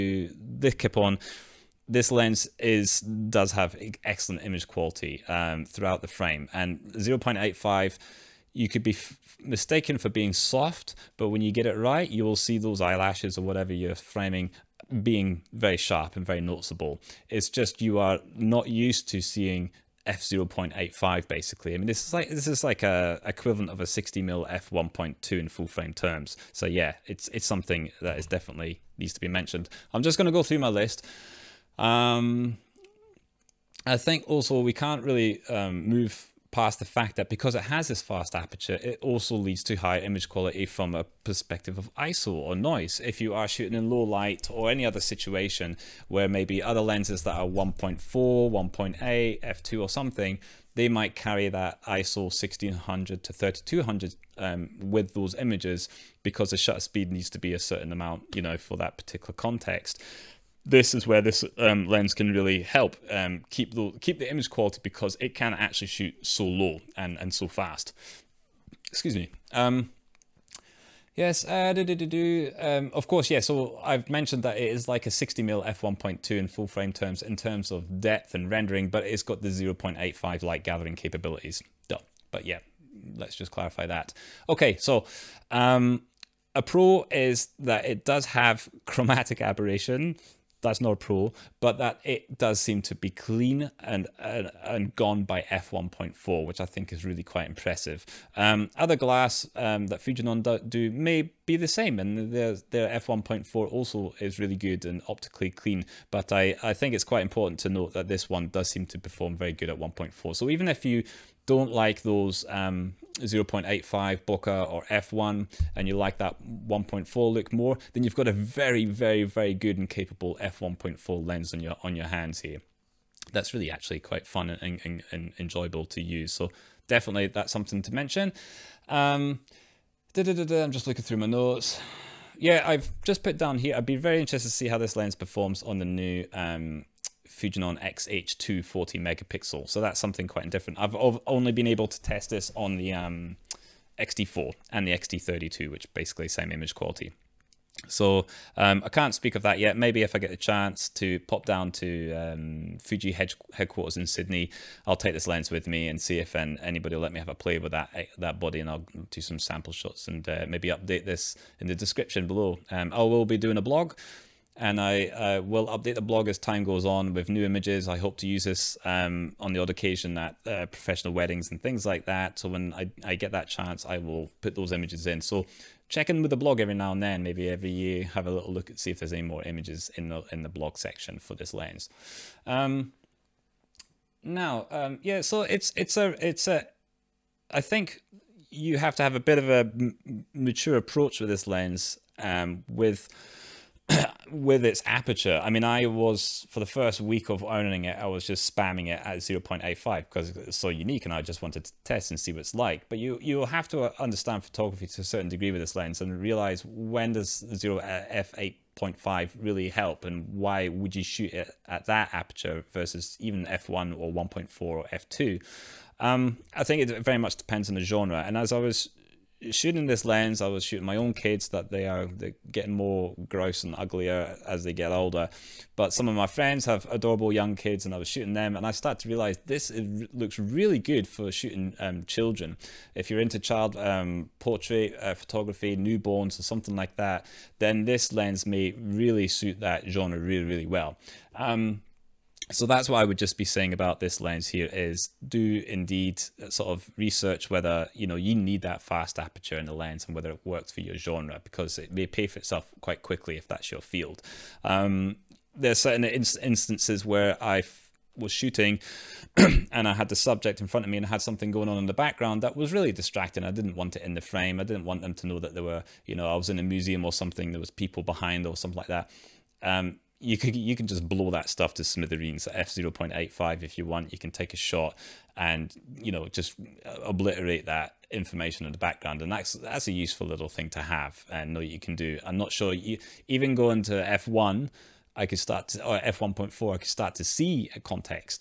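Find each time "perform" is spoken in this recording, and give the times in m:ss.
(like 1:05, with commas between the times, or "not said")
1:48, 2:15.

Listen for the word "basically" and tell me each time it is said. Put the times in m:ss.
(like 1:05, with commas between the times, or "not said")
0:21, 2:25.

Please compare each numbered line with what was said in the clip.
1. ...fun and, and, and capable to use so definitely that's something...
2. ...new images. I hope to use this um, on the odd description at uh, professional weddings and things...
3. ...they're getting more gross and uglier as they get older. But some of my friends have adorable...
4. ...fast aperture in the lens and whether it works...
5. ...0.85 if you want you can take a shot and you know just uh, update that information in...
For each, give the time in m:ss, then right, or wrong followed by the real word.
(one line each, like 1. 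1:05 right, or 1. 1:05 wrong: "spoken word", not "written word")
1. 2:04 wrong: "enjoyable", not "capable"
2. 2:47 wrong: "occasion", not "description"
3. 3:42 right
4. 4:08 right
5. 4:32 wrong: "obliterate", not "update".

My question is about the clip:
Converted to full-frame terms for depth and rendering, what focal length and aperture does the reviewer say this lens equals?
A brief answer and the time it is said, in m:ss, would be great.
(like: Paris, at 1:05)
60mm f1.2, at 0:23.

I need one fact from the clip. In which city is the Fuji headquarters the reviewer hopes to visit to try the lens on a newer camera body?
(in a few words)
Sydney.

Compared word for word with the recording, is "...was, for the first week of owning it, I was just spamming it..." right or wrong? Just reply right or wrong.
right.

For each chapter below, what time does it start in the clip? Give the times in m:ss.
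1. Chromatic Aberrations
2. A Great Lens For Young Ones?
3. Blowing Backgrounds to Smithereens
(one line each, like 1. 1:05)
1. 1:24
2. 3:06
3. 4:14.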